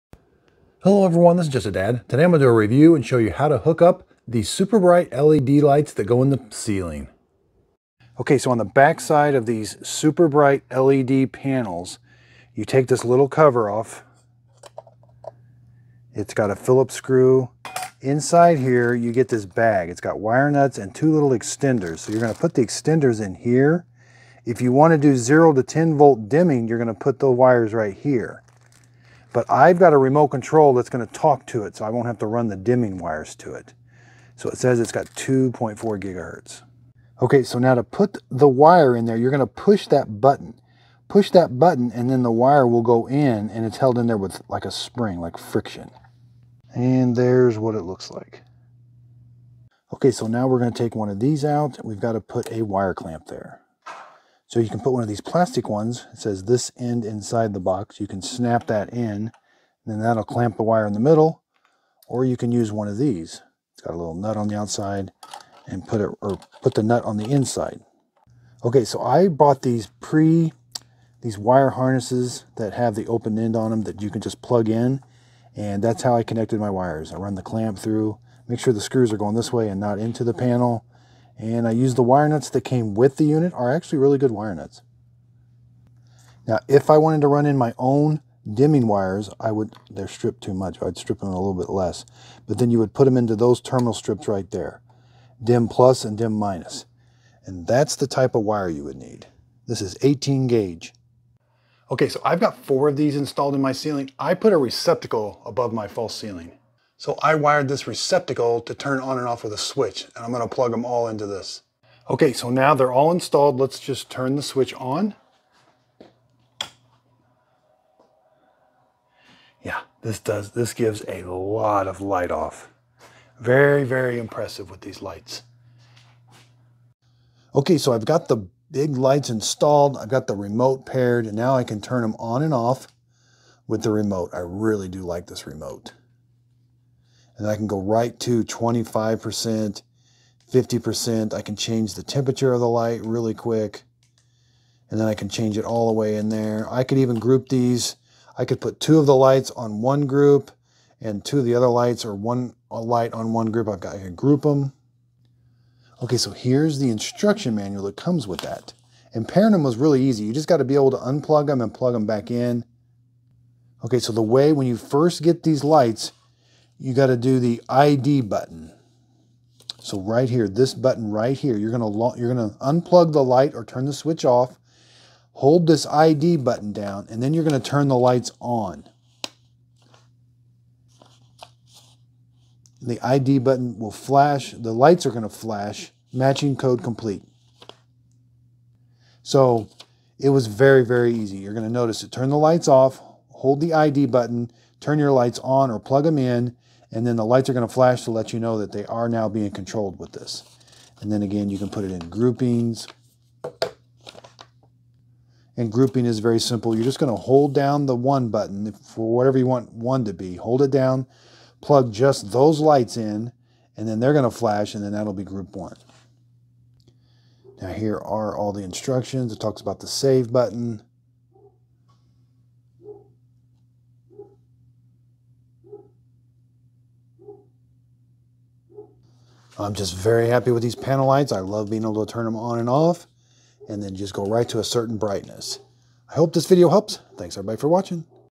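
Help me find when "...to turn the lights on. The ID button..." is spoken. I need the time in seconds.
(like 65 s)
177 s.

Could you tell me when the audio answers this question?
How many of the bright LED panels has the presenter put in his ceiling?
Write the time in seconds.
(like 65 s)
102 s.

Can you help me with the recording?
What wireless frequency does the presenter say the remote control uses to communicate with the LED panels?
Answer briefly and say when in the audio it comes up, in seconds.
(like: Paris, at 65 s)
2.4 gigahertz, at 35 s.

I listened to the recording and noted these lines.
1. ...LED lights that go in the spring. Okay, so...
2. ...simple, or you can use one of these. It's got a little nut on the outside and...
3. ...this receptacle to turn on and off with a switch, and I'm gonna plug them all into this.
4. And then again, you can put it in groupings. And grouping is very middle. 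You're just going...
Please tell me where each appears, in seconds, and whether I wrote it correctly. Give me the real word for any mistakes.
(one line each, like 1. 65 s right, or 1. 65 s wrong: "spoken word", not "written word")
1. 5 s wrong: "ceiling", not "spring"
2. 60 s wrong: "middle", not "simple"
3. 107 s right
4. 200 s wrong: "simple", not "middle".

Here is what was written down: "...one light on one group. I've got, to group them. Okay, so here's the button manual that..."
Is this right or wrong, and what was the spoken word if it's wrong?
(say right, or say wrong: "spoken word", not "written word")
wrong: "instruction", not "button".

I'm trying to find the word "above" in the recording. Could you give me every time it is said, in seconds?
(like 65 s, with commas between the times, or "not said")
105 s.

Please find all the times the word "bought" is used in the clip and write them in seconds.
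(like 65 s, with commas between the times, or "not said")
69 s.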